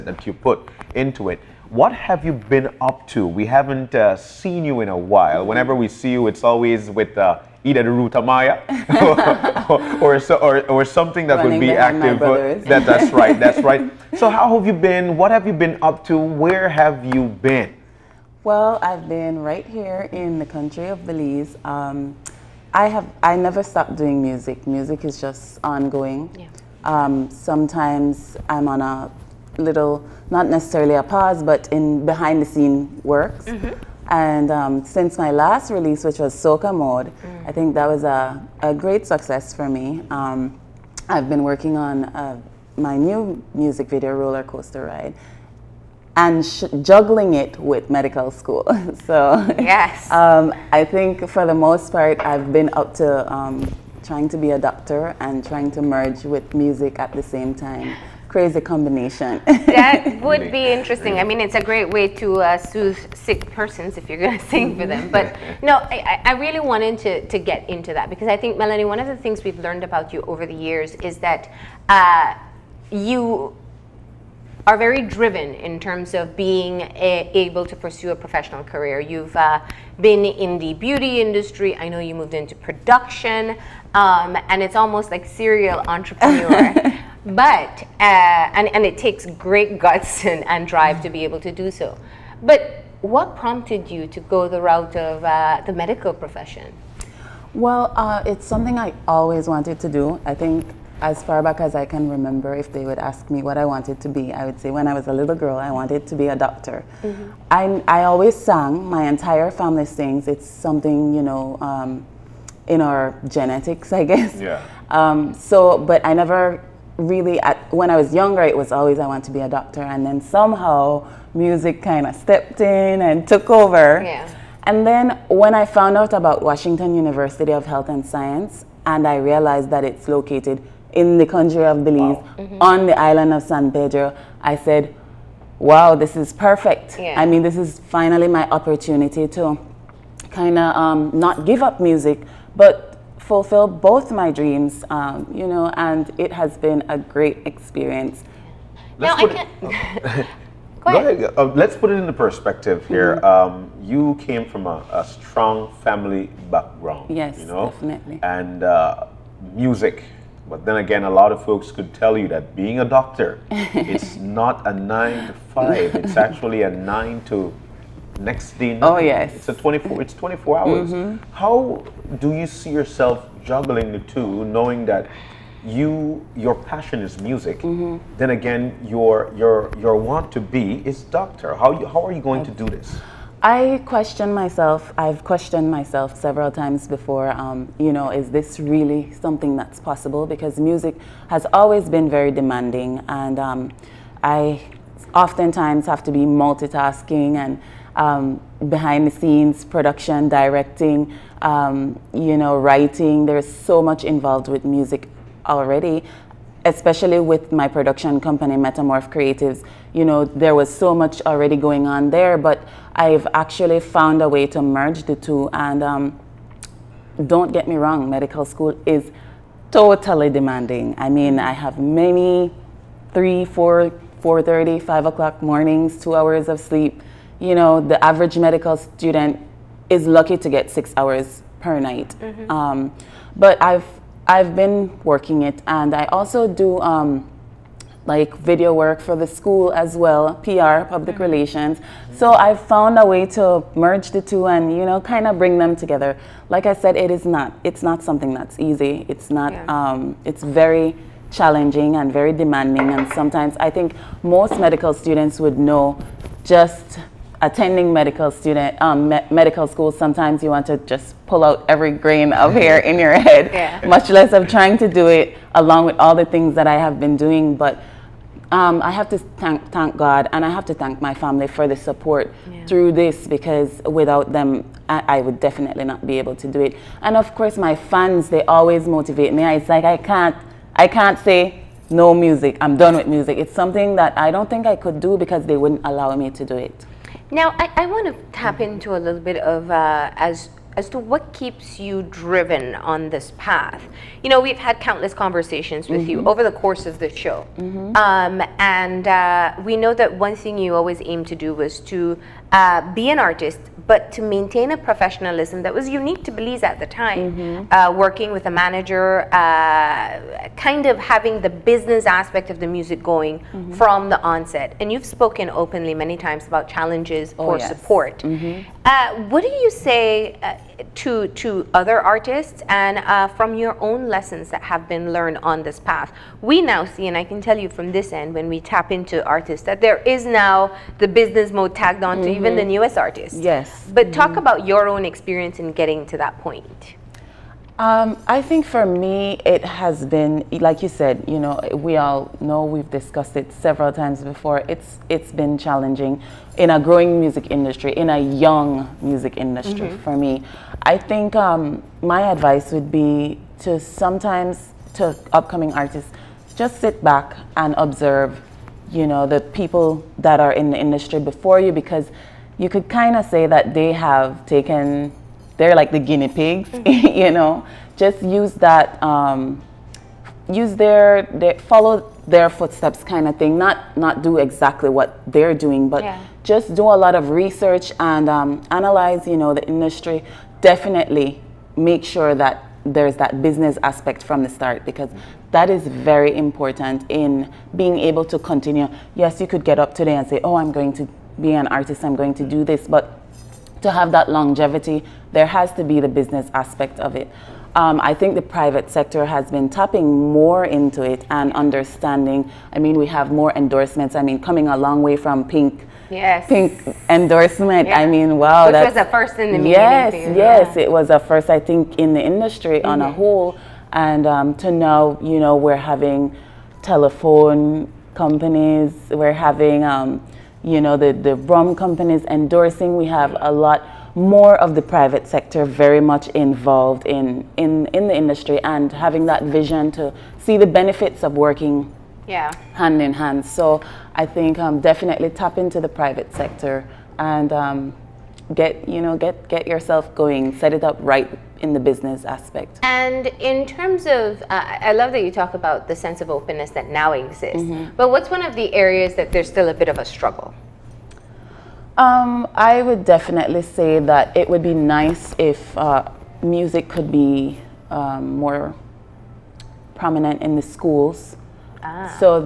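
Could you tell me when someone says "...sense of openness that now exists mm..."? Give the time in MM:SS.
07:25.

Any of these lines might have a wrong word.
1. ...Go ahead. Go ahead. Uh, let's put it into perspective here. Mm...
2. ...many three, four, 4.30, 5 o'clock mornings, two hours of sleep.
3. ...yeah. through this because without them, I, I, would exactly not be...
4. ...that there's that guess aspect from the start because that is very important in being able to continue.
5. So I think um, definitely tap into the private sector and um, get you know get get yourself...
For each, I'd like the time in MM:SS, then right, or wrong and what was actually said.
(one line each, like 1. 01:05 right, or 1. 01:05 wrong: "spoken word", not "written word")
1. 02:30 right
2. 03:41 right
3. 04:32 wrong: "definitely", not "exactly"
4. 06:22 wrong: "business", not "guess"
5. 07:13 right.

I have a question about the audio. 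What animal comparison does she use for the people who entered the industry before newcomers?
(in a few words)
Guinea pigs.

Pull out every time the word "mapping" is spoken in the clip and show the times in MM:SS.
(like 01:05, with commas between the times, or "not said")
not said.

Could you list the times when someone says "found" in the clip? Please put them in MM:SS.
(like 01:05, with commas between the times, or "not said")
02:05, 03:33, 04:02.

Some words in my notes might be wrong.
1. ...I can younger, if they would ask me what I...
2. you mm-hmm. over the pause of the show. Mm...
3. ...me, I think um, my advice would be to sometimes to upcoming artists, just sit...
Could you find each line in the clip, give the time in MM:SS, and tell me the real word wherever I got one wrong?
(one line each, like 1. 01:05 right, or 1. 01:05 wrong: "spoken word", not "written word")
1. 01:41 wrong: "remember", not "younger"
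2. 04:56 wrong: "course", not "pause"
3. 05:50 right.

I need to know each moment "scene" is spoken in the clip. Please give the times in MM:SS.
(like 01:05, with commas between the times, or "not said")
00:32, 03:19.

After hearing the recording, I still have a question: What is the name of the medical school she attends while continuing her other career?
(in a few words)
Washington University of Health and Science.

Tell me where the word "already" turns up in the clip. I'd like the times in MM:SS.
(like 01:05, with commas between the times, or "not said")
03:25, 03:31.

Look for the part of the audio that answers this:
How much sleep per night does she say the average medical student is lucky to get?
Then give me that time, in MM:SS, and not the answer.
03:50.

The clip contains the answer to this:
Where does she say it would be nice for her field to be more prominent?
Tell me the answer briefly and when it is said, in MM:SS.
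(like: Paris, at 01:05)
Schools, at 07:40.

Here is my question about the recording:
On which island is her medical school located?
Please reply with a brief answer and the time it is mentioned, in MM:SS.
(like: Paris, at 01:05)
San Pedro, at 02:13.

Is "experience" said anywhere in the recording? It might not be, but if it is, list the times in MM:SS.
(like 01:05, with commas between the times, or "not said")
02:27, 05:35.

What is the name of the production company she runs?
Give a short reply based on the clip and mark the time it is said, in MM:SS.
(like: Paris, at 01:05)
Metamorph Creatives, at 03:28.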